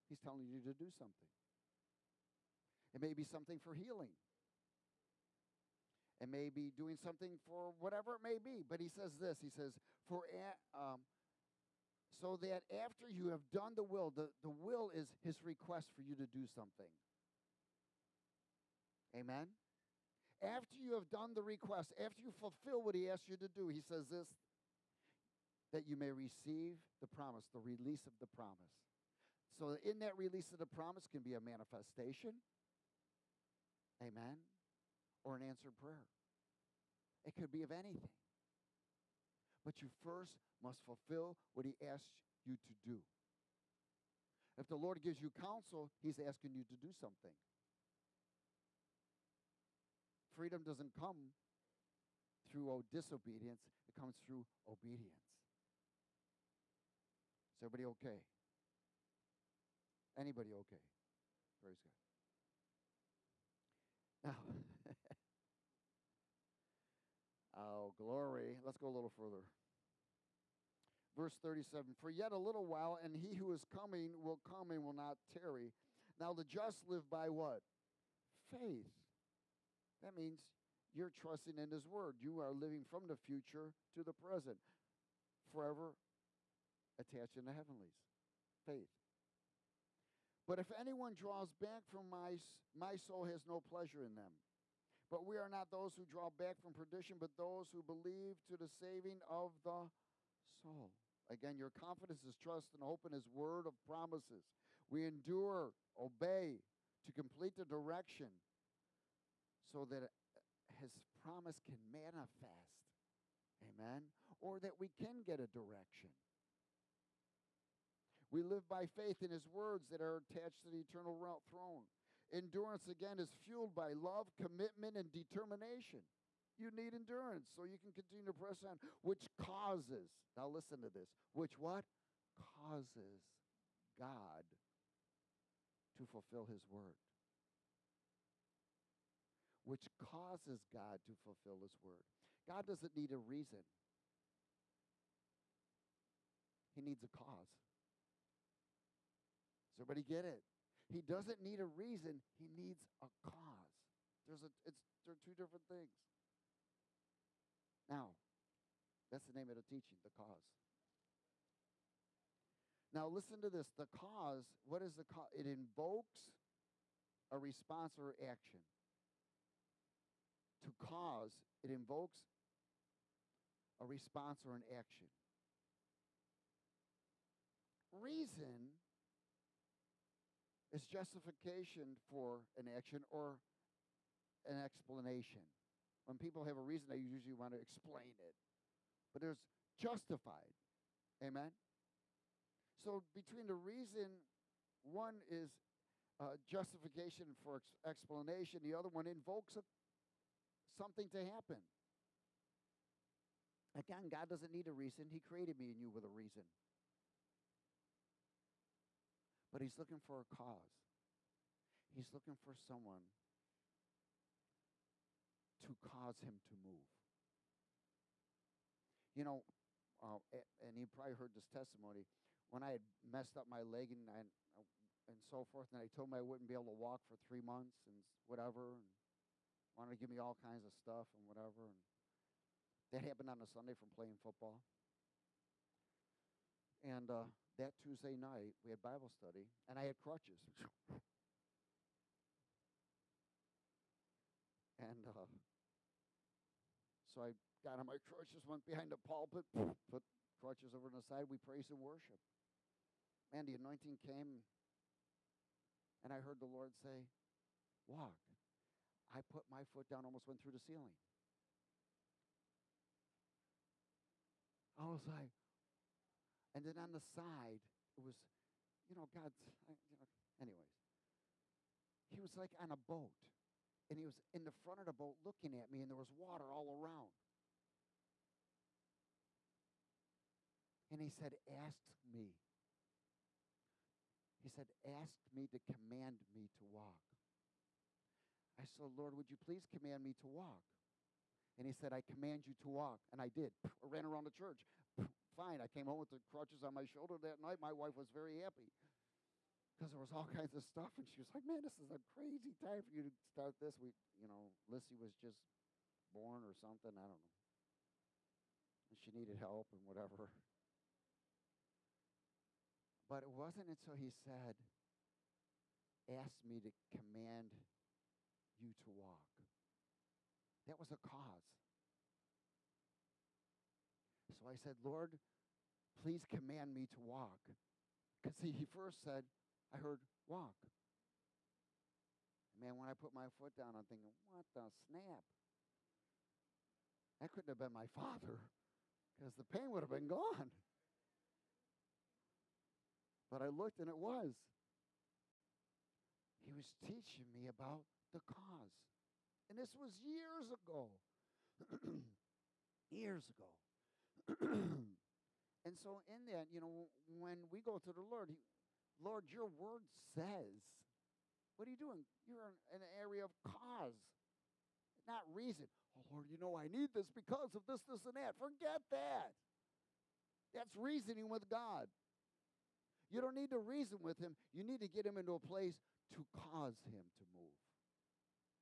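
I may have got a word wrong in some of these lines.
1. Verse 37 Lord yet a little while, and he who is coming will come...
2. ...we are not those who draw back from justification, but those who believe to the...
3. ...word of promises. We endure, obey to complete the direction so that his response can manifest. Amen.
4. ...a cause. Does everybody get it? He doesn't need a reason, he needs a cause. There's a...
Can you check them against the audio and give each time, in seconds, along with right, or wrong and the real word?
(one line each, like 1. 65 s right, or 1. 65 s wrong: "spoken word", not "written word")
1. 71 s wrong: "For", not "Lord"
2. 95 s wrong: "perdition", not "justification"
3. 103 s wrong: "promise", not "response"
4. 147 s right.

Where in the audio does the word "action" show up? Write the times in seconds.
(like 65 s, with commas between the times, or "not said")
168 s, 174 s, 182 s.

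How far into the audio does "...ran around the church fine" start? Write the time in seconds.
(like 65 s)
293 s.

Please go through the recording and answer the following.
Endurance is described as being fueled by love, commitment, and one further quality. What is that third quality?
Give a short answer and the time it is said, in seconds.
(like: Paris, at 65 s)
determination, at 125 s.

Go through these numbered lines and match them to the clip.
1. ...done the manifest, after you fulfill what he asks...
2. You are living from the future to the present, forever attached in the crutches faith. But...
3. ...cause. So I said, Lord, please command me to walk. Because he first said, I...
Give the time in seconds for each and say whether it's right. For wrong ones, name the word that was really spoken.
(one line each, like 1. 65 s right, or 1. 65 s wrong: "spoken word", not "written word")
1. 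21 s wrong: "request", not "manifest"
2. 82 s wrong: "heavenlies", not "crutches"
3. 320 s right.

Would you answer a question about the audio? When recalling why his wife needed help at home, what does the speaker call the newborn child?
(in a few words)
Lissy.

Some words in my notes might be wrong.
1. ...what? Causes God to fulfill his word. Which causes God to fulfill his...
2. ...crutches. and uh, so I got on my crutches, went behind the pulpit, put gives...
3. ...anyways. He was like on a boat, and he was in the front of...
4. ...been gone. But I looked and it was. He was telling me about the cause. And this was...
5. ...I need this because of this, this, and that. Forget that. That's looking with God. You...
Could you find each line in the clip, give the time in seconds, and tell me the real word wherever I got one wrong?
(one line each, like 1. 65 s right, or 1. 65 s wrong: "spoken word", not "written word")
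1. 131 s right
2. 239 s wrong: "crutches", not "gives"
3. 270 s right
4. 339 s wrong: "teaching", not "telling"
5. 366 s wrong: "reasoning", not "looking".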